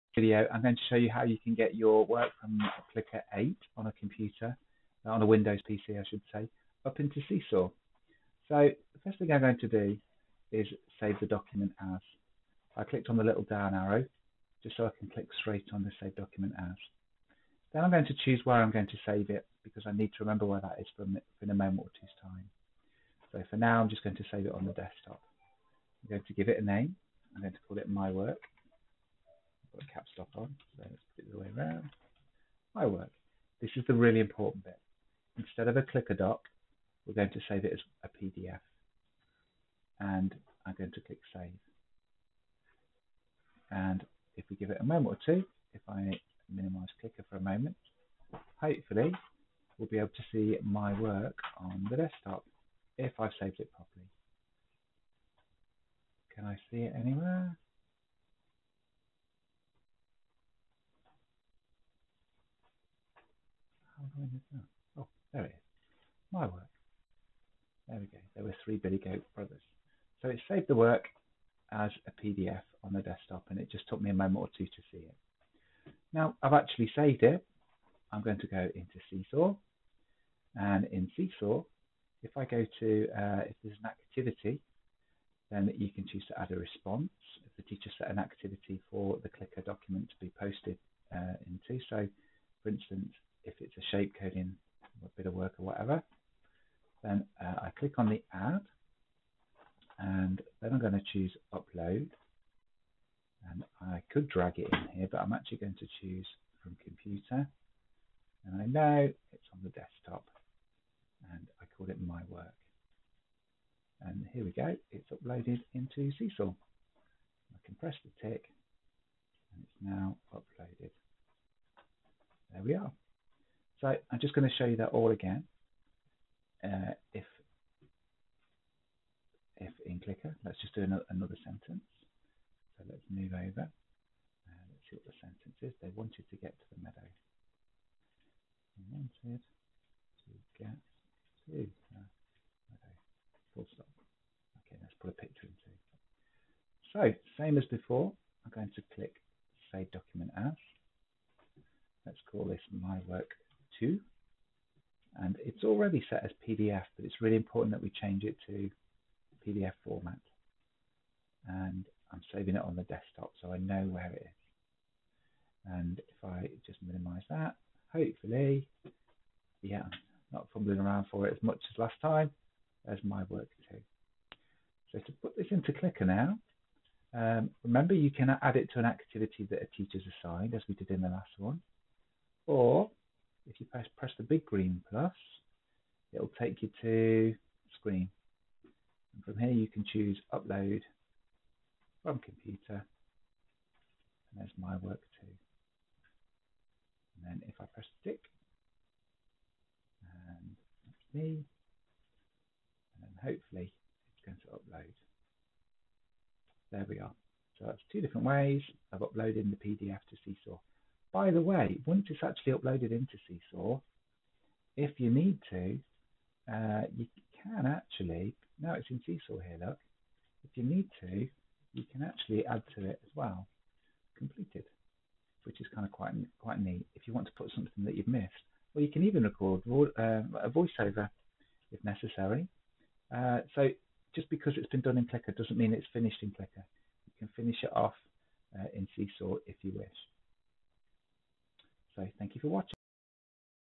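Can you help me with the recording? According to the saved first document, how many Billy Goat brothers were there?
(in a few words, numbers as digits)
3.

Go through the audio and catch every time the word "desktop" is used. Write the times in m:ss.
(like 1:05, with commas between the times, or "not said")
0:24, 0:51, 1:13, 1:49, 2:42.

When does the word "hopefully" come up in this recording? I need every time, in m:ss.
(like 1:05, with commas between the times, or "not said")
0:48, 2:47, 3:23.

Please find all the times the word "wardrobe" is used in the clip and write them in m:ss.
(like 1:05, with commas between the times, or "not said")
not said.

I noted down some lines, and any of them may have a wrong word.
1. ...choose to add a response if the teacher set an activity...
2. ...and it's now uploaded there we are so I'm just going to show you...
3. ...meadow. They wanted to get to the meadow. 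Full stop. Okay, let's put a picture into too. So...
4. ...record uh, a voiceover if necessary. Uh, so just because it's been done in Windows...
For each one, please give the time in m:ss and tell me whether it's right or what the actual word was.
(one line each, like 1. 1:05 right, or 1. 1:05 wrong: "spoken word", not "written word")
1. 1:26 right
2. 1:59 right
3. 2:16 right
4. 3:49 wrong: "Clicker", not "Windows".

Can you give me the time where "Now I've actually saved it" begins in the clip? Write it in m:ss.
1:16.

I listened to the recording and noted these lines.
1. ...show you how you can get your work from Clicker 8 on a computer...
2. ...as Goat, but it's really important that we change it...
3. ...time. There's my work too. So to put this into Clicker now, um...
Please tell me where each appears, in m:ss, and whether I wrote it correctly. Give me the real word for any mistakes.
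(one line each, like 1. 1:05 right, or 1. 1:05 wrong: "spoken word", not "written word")
1. 0:00 right
2. 2:36 wrong: "PDF", not "Goat"
3. 2:52 right.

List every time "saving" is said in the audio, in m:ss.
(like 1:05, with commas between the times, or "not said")
2:42.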